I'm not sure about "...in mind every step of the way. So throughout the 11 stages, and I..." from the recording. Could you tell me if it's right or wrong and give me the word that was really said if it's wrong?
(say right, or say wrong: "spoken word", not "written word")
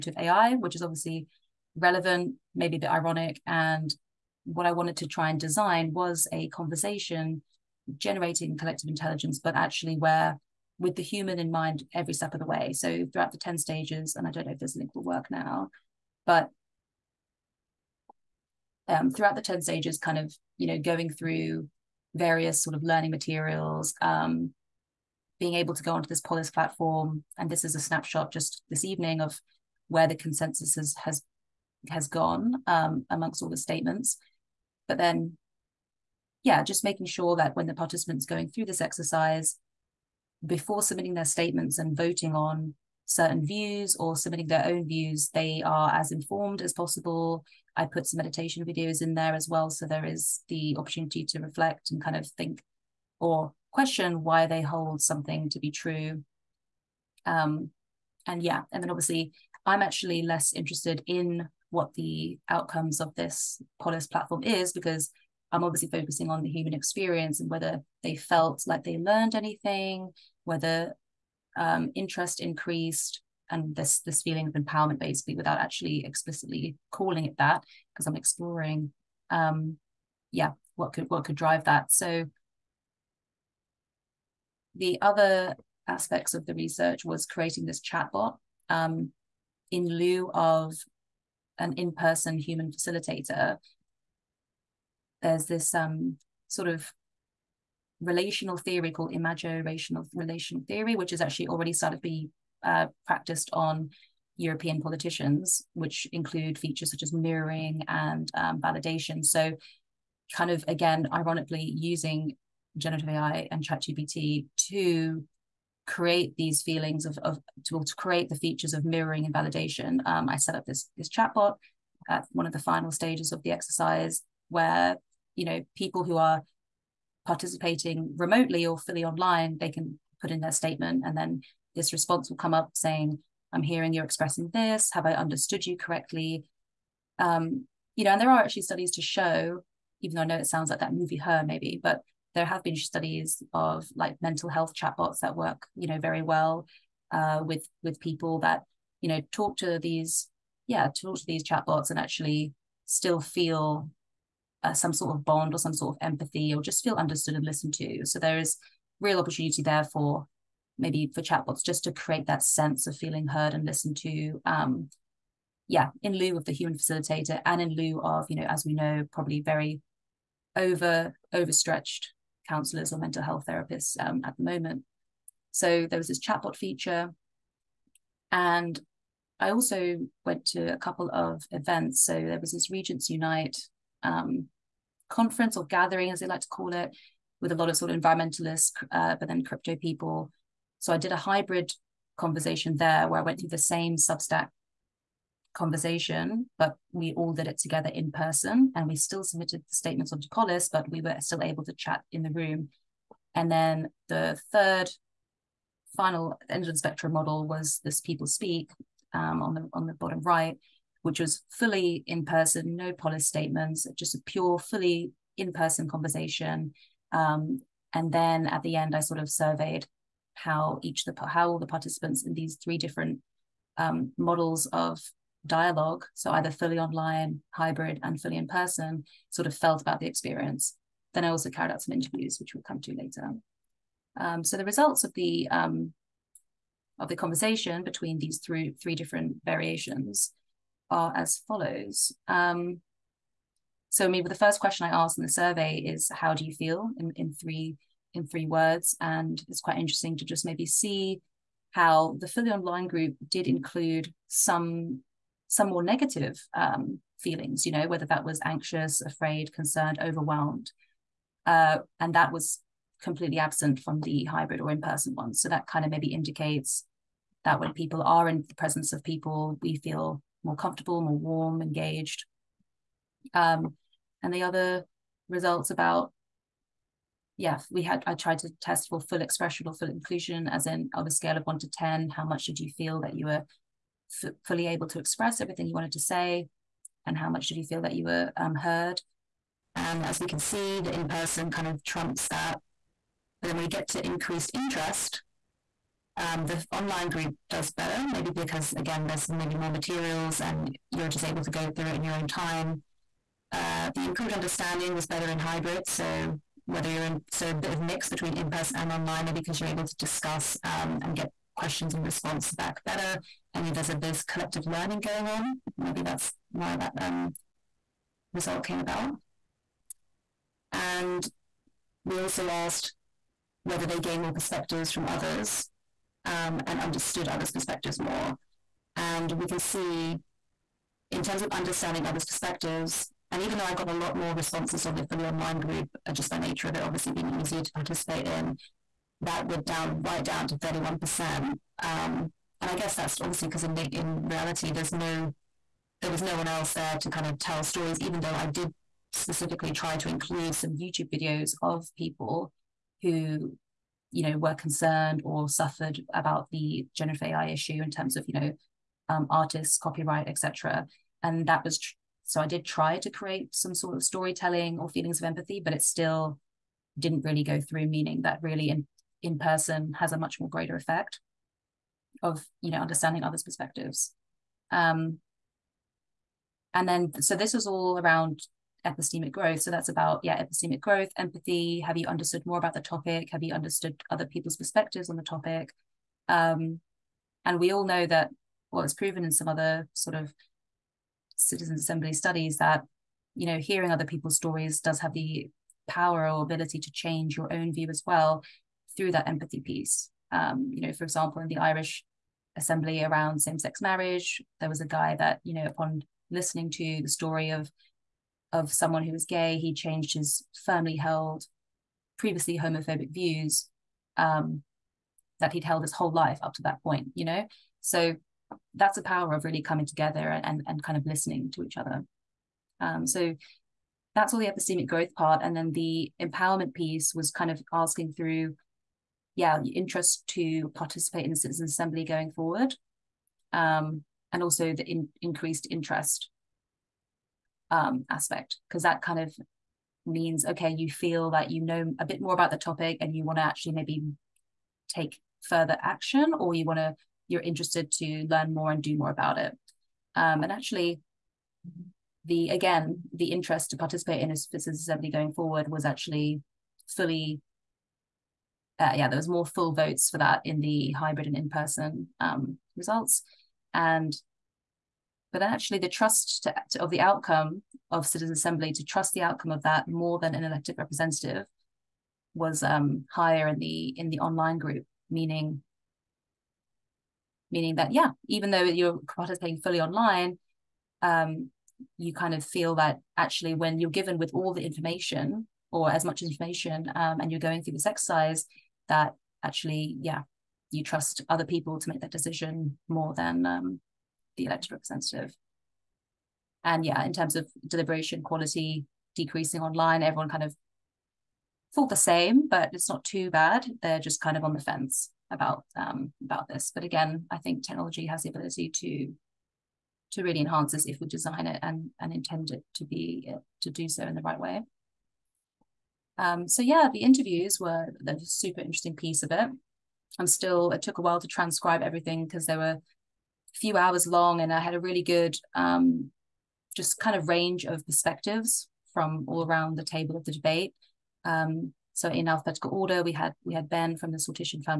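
wrong: "10", not "11".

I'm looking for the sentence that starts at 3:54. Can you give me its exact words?
Um, so the results of the um, of the conversation between these three three different variations are as follows.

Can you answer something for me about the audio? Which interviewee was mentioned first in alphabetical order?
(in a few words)
Ben.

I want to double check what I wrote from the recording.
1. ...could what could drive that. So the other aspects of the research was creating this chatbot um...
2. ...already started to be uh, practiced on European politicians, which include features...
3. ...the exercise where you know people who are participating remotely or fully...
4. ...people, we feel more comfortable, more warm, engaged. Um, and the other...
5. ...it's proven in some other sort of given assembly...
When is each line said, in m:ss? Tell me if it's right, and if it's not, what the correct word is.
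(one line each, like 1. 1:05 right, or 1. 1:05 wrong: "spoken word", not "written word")
1. 1:20 right
2. 1:41 right
3. 2:03 right
4. 4:29 right
5. 6:28 wrong: "citizen", not "given".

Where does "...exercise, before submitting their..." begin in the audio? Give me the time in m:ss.
0:38.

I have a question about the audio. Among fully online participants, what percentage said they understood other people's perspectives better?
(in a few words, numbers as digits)
31%.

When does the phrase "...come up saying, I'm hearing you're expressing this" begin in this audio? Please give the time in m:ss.
2:12.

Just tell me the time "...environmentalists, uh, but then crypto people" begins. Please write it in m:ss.
3:07.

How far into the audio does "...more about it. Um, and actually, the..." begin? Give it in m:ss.
7:28.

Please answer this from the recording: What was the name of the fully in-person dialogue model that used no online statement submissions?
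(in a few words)
People Speak.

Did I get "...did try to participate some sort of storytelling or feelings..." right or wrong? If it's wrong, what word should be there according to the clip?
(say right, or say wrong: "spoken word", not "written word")
wrong: "create", not "participate".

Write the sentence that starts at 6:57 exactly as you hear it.
So that's the power of really coming together and, and kind of listening to each other.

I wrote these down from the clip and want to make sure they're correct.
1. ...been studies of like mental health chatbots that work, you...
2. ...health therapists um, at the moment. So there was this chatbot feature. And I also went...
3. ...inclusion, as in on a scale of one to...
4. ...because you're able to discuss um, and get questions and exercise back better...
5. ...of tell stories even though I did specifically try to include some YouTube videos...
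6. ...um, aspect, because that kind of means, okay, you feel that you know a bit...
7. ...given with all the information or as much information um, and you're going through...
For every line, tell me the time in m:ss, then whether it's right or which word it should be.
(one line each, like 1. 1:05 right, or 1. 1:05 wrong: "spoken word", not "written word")
1. 2:22 right
2. 2:53 right
3. 4:39 right
4. 5:09 wrong: "response", not "exercise"
5. 5:47 right
6. 7:17 right
7. 8:03 right.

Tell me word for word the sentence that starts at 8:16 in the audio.
And yeah, in terms of deliberation quality decreasing online, everyone kind of thought the same, but it's not too bad.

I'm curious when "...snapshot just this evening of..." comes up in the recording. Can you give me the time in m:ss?
0:27.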